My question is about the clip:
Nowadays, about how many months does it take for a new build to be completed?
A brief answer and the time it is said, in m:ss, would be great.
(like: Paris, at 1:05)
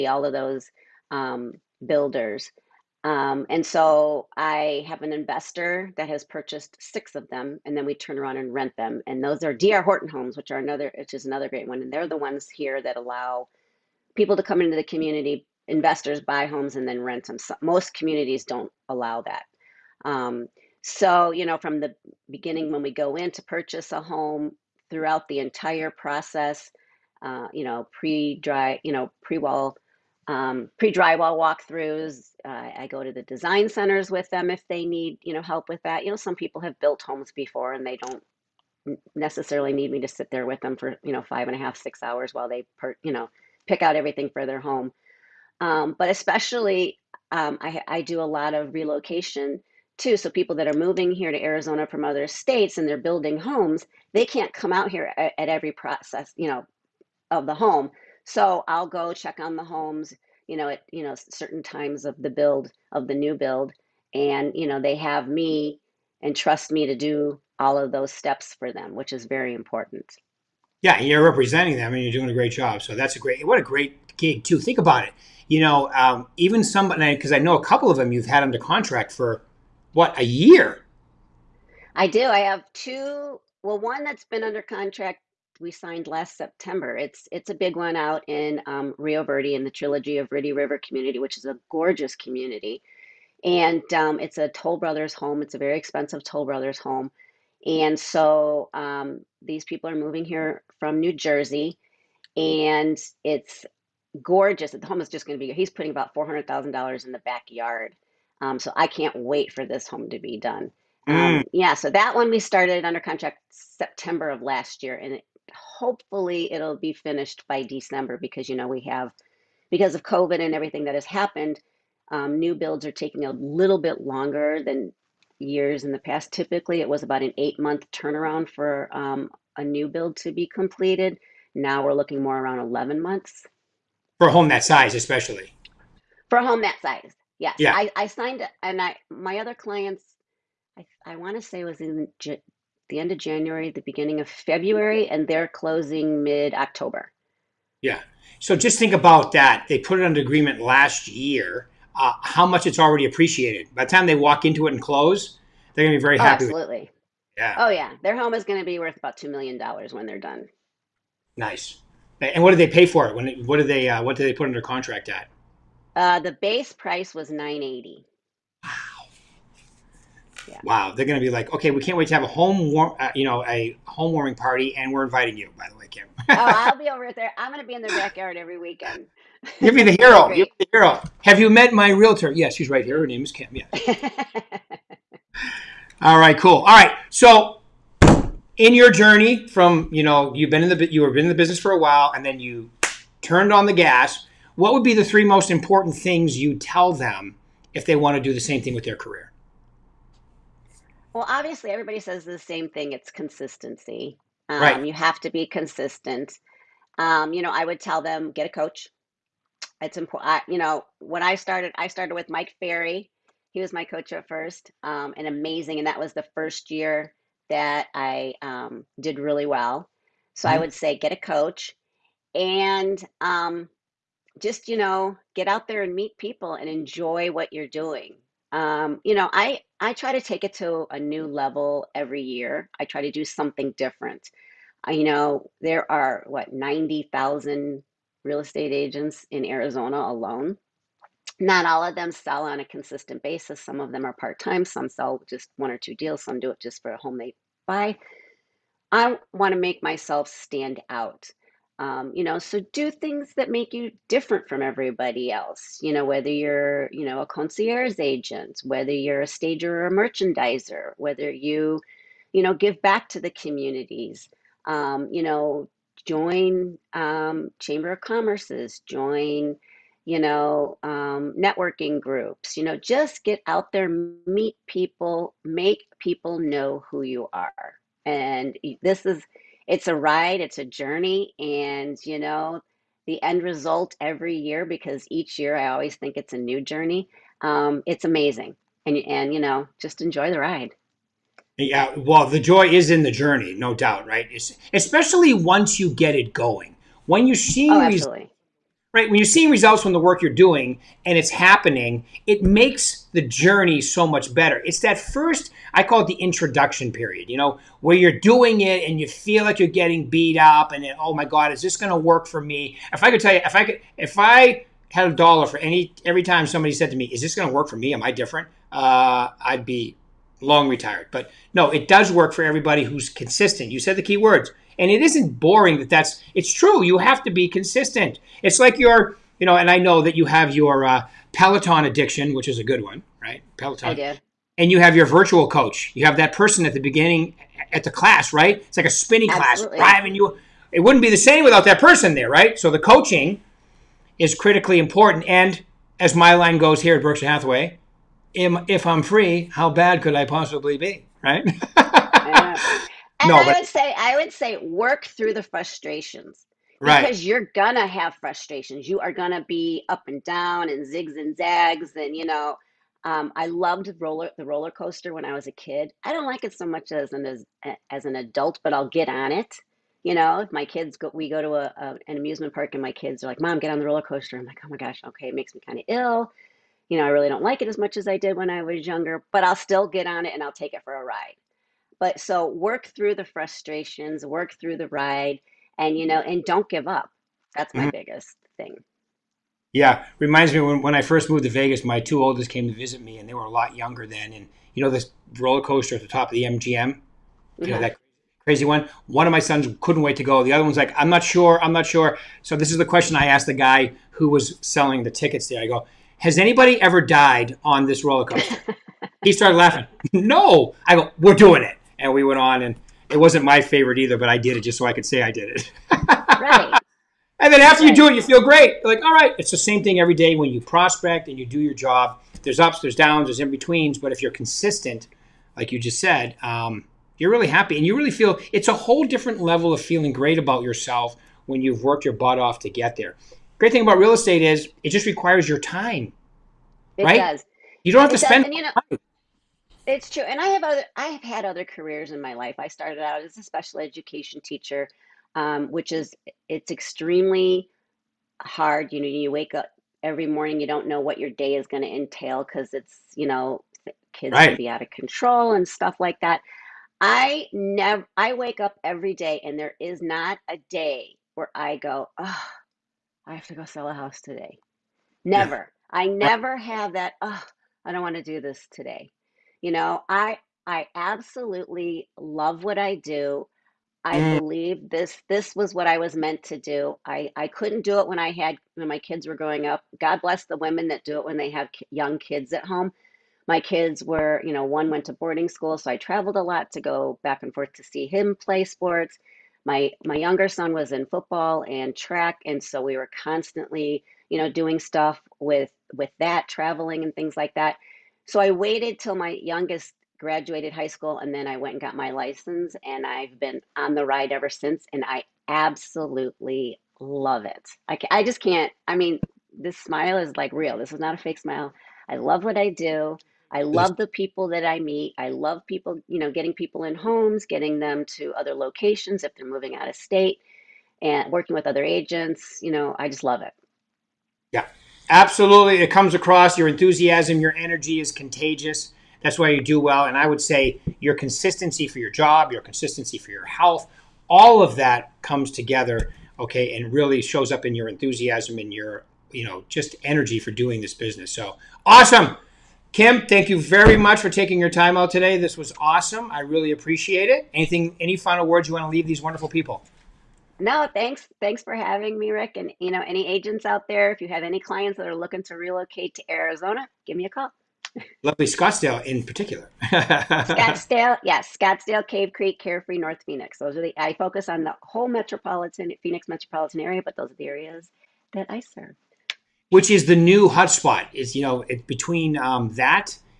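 11 months, at 2:12.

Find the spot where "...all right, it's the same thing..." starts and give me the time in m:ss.
6:59.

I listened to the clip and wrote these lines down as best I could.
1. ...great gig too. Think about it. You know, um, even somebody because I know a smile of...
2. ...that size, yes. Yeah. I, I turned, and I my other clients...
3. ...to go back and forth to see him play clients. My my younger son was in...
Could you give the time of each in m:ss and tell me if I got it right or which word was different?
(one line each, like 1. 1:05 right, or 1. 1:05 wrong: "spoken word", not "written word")
1. 1:13 wrong: "couple", not "smile"
2. 2:16 wrong: "signed", not "turned"
3. 8:06 wrong: "sports", not "clients".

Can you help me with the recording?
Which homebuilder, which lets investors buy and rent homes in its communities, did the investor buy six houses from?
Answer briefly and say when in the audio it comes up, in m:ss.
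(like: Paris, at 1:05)
D.R. Horton, at 0:09.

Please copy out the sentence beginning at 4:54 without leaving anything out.
It's, especially once you get it going, when you see.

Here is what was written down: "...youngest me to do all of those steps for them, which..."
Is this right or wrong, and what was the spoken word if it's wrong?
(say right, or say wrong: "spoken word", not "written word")
wrong: "trust", not "youngest".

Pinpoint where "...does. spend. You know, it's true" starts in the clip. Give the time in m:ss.
7:18.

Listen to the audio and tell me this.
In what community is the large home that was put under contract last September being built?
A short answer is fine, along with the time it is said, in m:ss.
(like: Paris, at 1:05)
Trilogy of Verde River, at 1:29.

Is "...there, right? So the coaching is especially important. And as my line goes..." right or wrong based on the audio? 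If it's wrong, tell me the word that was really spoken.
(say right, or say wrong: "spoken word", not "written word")
wrong: "critically", not "especially".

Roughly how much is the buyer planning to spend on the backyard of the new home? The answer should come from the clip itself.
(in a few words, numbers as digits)
$400,000.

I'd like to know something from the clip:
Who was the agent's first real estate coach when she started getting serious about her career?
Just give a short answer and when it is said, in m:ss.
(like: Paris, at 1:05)
Mike Ferry, at 3:32.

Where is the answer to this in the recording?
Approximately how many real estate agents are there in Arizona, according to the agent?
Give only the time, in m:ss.
3:56.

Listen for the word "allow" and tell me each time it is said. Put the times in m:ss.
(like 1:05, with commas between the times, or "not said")
0:12, 0:18.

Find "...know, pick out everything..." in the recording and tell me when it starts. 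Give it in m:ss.
0:43.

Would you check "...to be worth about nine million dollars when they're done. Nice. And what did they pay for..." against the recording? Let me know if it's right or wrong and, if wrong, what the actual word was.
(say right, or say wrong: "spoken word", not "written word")
wrong: "two", not "nine".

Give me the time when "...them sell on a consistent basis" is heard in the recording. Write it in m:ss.
4:01.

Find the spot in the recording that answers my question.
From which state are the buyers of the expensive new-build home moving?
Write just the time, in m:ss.
1:40.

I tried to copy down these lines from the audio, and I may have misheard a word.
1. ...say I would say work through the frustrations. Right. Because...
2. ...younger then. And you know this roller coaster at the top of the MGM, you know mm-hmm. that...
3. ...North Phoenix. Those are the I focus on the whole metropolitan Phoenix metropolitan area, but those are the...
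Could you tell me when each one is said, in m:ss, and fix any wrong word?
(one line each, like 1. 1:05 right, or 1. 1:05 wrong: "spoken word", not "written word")
1. 5:53 right
2. 6:33 right
3. 9:22 right.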